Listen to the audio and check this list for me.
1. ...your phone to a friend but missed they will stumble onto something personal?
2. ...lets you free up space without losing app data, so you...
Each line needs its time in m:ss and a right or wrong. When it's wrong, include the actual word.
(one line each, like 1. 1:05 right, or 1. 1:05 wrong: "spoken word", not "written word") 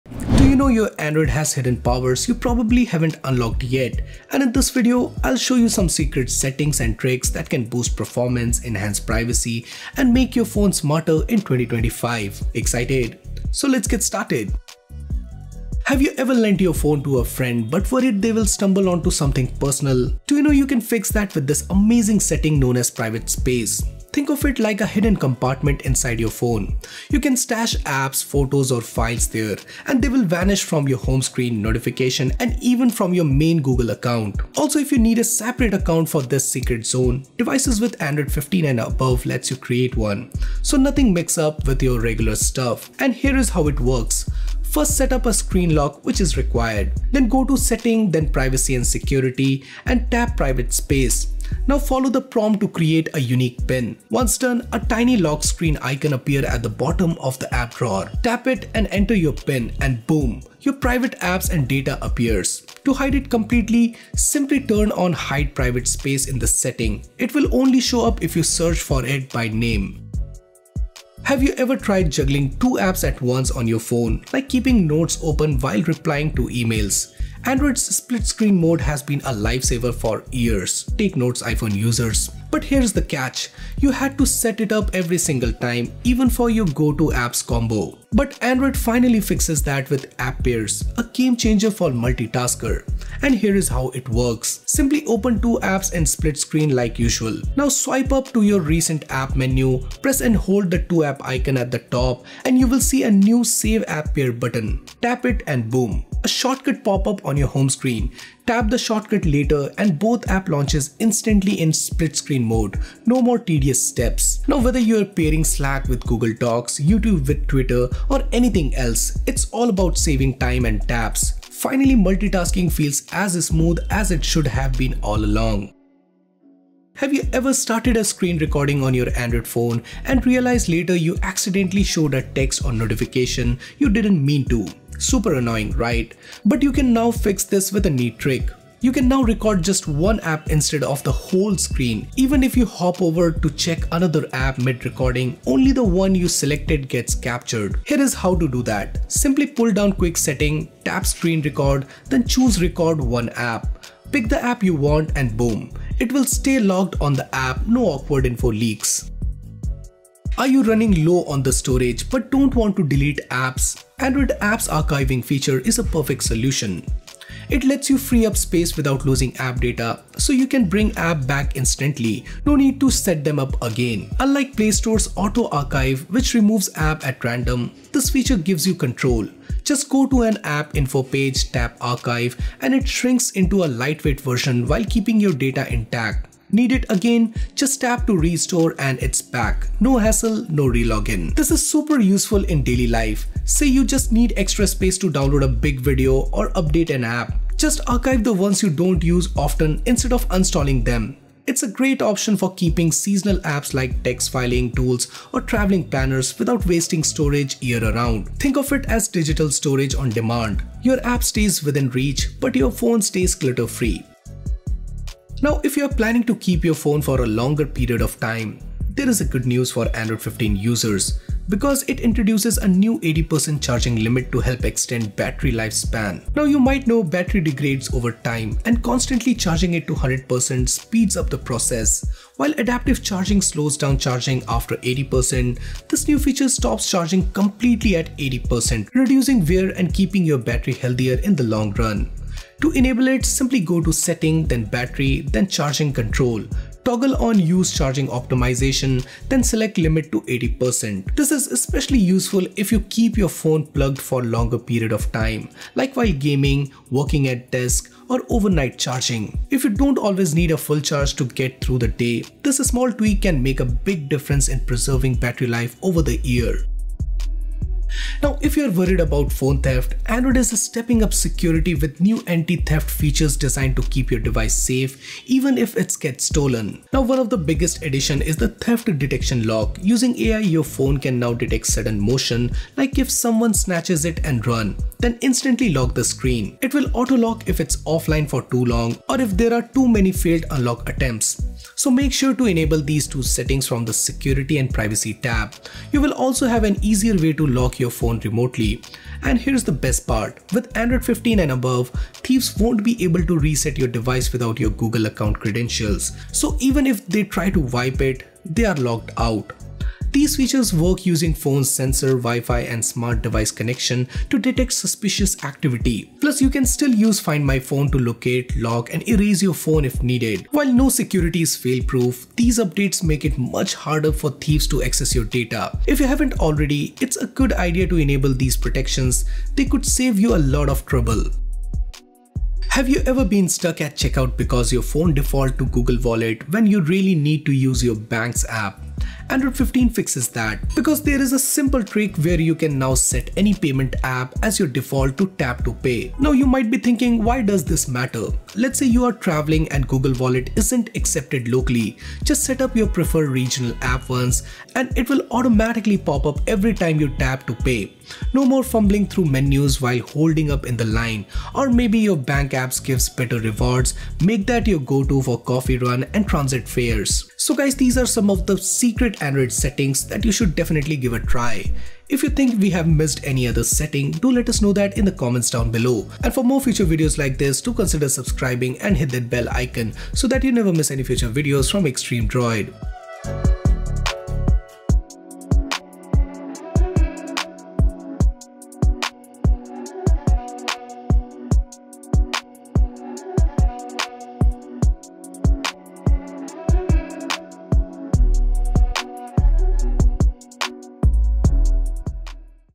1. 0:16 wrong: "worried", not "missed"
2. 2:47 right.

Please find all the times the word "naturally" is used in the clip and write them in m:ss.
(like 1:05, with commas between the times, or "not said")
not said.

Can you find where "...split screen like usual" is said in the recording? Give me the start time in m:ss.
1:36.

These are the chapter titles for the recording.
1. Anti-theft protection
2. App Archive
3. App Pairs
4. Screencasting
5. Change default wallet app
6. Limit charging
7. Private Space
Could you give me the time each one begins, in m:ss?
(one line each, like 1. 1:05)
1. 4:27
2. 2:40
3. 1:11
4. 2:07
5. 5:32
6. 3:35
7. 0:20.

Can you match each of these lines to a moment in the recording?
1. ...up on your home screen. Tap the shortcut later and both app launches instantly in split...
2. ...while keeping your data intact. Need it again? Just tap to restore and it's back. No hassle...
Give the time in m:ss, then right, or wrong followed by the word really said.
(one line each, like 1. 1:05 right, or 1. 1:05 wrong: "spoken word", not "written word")
1. 1:47 right
2. 3:04 right.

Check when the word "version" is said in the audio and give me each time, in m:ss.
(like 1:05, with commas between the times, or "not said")
3:04.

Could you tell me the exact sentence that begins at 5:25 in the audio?
If you haven't already, it's a good idea to enable these protections.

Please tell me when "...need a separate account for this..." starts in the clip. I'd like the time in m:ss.
0:34.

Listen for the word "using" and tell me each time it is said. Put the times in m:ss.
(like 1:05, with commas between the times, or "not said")
4:39, 5:11.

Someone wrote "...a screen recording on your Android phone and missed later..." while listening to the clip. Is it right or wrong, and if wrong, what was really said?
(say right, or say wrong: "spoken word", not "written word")
wrong: "realized", not "missed".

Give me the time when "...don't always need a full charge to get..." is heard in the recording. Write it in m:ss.
4:19.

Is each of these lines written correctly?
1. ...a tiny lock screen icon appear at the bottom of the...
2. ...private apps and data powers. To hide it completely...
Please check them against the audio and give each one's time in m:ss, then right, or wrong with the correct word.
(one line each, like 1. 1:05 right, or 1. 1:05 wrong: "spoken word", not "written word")
1. 0:54 right
2. 1:00 wrong: "appears", not "powers".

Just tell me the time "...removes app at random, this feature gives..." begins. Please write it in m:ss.
2:56.